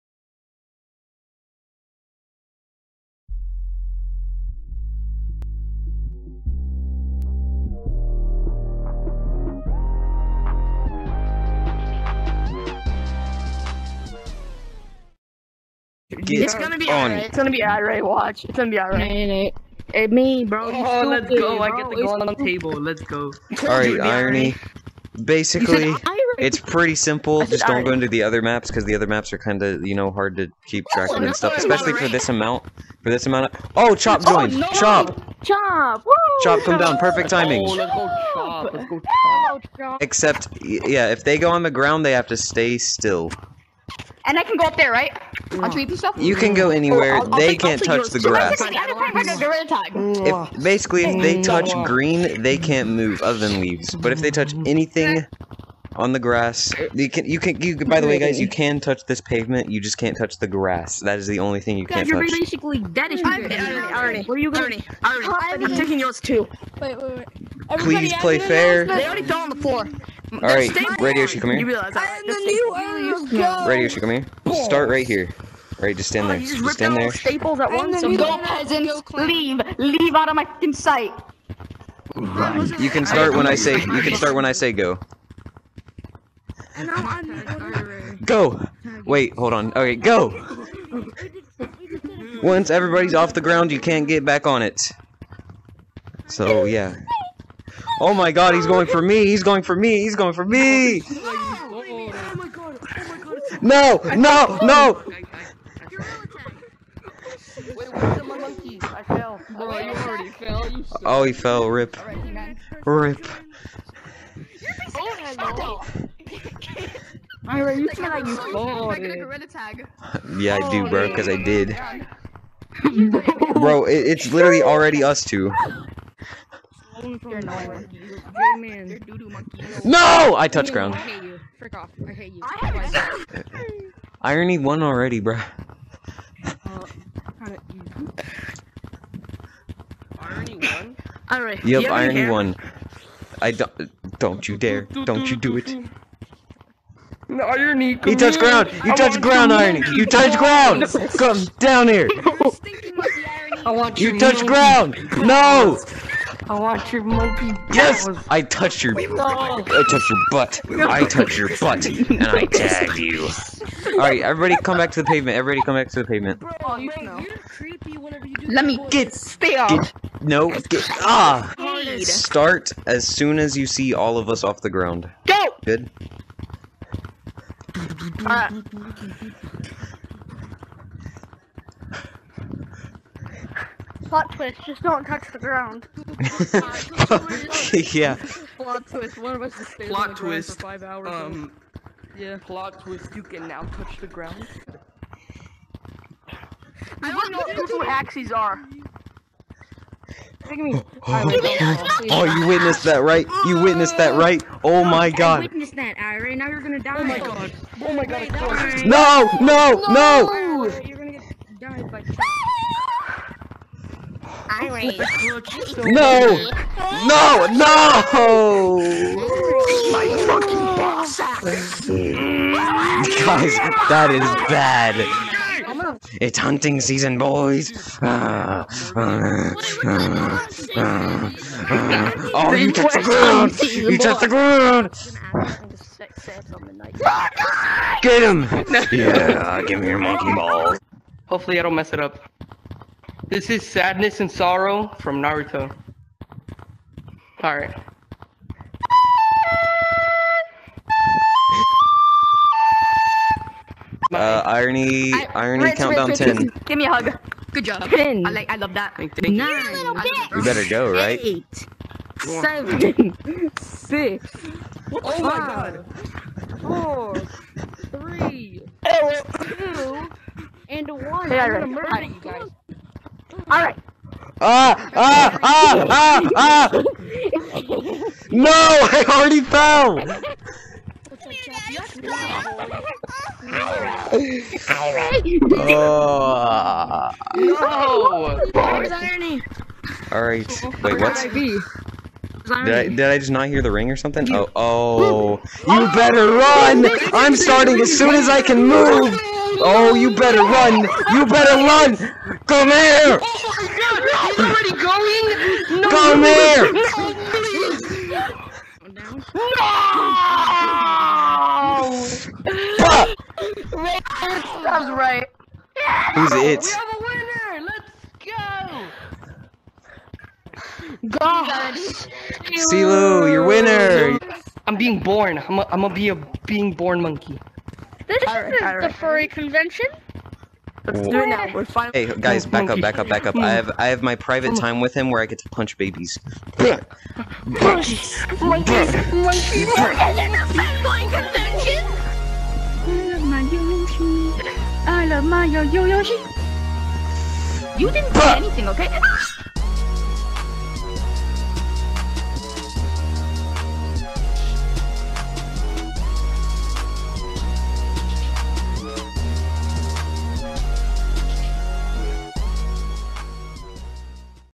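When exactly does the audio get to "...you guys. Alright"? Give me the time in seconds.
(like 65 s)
272 s.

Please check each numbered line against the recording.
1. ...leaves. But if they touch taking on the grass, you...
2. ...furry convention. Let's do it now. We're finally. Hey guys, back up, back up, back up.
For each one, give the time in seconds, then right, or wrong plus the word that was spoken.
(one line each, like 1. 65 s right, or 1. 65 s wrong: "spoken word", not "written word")
1. 53 s wrong: "anything", not "taking"
2. 328 s right.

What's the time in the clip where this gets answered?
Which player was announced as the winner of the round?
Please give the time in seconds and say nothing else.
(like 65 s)
322 s.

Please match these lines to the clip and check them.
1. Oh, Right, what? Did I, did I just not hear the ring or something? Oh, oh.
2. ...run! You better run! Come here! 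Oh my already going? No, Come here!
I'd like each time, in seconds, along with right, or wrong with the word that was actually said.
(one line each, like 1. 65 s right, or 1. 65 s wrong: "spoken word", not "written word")
1. 290 s wrong: "Wait", not "Right"
2. 300 s right.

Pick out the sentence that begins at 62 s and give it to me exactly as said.
you're basically dead I'm you Arnie, Where are you going?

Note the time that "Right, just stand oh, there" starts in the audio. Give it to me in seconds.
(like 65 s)
75 s.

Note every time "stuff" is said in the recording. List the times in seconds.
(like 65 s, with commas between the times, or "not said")
31 s, 45 s.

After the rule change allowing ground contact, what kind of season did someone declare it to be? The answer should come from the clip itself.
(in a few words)
hunting season.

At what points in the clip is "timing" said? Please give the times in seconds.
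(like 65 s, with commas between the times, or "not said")
37 s.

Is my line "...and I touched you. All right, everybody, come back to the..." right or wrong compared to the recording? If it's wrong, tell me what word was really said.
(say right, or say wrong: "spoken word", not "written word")
wrong: "tagged", not "touched".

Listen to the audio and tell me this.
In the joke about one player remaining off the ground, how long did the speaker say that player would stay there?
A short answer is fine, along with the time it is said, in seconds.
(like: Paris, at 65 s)
5 hours, at 190 s.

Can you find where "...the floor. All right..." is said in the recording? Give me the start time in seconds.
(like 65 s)
69 s.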